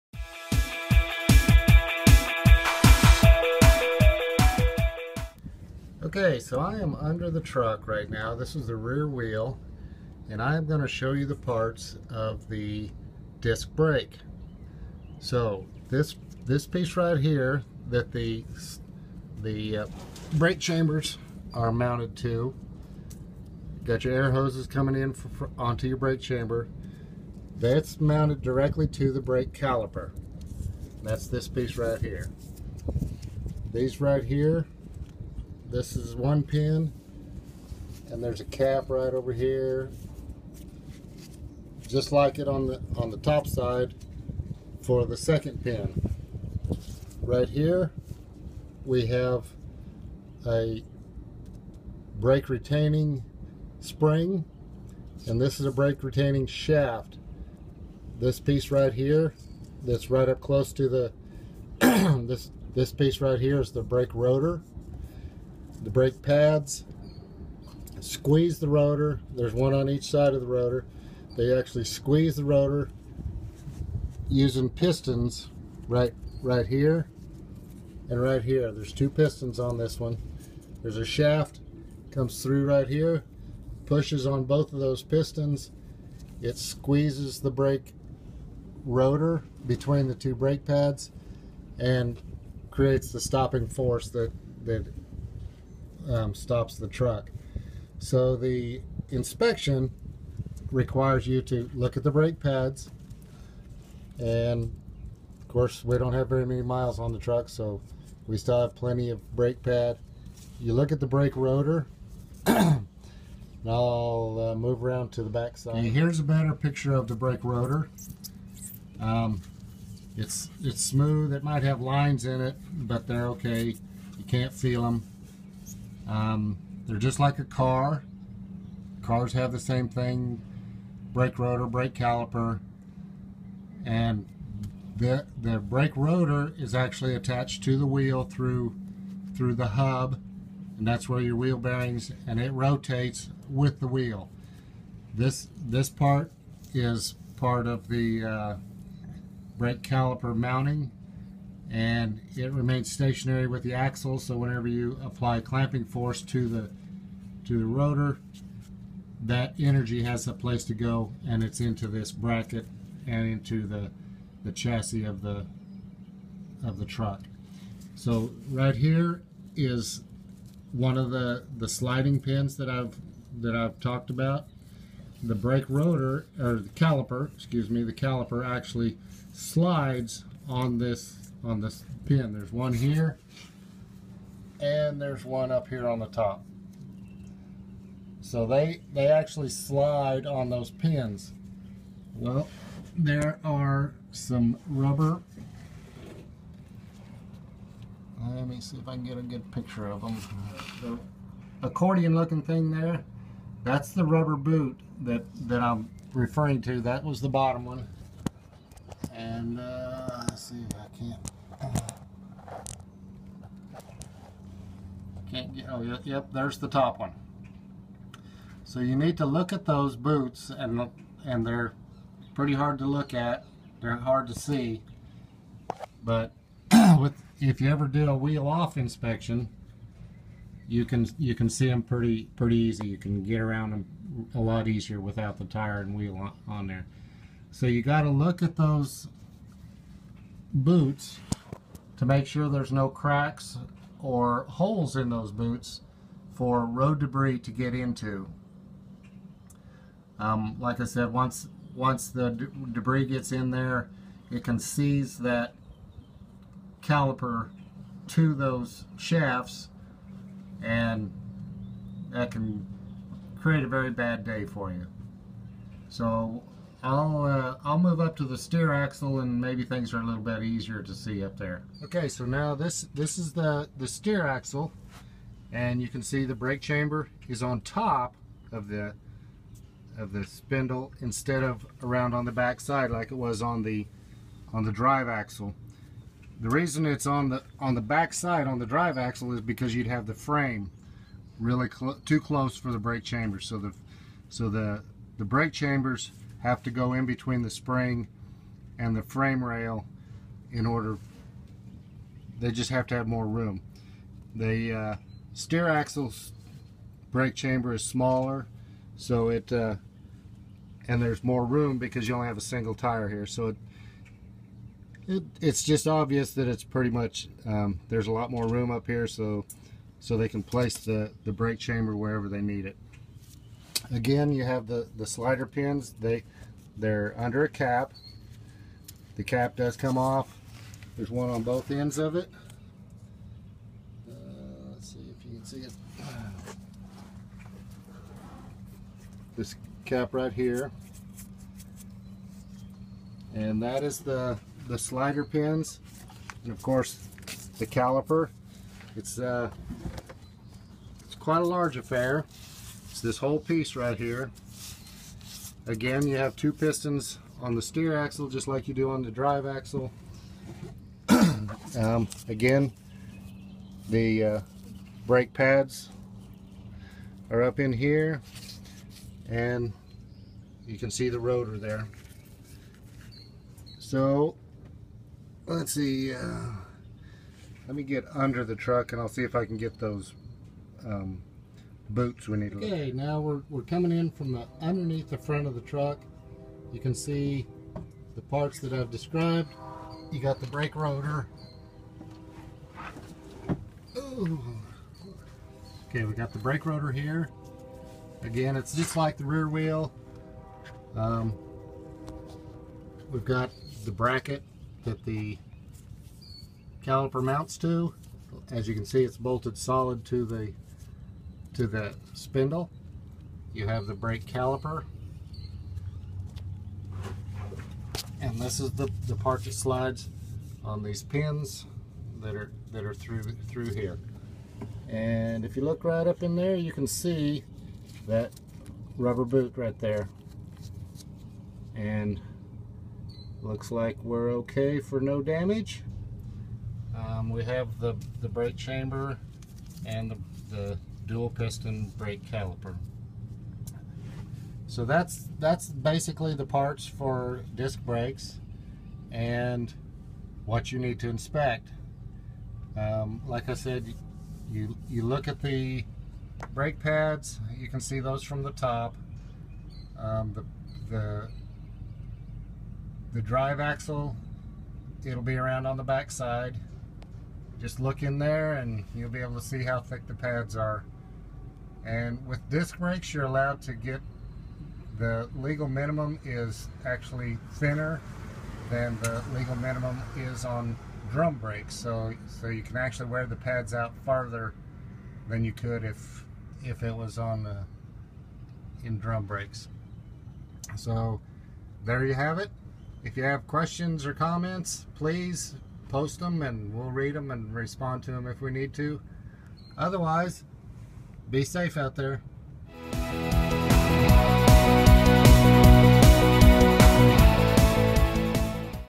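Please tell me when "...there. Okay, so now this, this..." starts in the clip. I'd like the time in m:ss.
4:31.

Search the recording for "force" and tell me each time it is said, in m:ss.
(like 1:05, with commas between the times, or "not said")
1:33, 2:35.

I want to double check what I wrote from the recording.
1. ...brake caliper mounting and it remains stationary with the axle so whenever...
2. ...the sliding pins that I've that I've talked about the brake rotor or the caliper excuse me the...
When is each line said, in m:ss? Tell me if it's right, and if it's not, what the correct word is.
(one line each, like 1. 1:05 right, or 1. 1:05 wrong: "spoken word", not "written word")
1. 2:29 right
2. 2:51 right.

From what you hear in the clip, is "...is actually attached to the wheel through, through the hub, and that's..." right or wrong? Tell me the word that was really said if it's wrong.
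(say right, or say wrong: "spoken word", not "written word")
right.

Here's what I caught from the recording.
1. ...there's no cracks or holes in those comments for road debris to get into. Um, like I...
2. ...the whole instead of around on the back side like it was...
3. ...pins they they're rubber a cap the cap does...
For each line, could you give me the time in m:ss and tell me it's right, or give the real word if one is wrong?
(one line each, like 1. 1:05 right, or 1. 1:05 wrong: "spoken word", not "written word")
1. 4:02 wrong: "boots", not "comments"
2. 4:40 wrong: "spindle", not "whole"
3. 5:25 wrong: "under", not "rubber".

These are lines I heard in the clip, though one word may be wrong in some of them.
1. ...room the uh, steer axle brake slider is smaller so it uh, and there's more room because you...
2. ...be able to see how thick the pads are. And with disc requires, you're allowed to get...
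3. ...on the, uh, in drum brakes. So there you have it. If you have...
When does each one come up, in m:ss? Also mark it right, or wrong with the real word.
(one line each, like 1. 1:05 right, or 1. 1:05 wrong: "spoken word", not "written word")
1. 5:03 wrong: "chamber", not "slider"
2. 7:49 wrong: "brakes", not "requires"
3. 8:07 right.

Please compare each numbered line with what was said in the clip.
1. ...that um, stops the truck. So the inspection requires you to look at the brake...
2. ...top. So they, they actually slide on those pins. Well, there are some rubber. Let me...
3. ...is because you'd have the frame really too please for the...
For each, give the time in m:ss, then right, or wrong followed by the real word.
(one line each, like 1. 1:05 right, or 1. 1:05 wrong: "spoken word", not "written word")
1. 1:34 right
2. 3:06 right
3. 4:49 wrong: "close", not "please".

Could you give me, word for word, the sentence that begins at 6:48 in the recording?
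As you can see, it's bolted solid to the to the spindle.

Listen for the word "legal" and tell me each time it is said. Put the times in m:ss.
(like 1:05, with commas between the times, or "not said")
7:55, 7:59.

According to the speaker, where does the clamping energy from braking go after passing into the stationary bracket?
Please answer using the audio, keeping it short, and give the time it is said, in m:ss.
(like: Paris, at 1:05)
The chassis, at 2:44.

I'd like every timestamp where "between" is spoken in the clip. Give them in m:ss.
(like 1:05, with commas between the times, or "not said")
1:29, 4:57.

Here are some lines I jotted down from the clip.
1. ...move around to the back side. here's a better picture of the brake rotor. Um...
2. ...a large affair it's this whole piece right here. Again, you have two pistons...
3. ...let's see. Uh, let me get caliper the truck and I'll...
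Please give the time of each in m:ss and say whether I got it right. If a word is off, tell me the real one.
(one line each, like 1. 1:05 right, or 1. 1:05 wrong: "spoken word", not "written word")
1. 1:54 right
2. 5:51 right
3. 6:15 wrong: "under", not "caliper".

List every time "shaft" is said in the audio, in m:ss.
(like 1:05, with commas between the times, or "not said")
0:56, 1:21, 4:18.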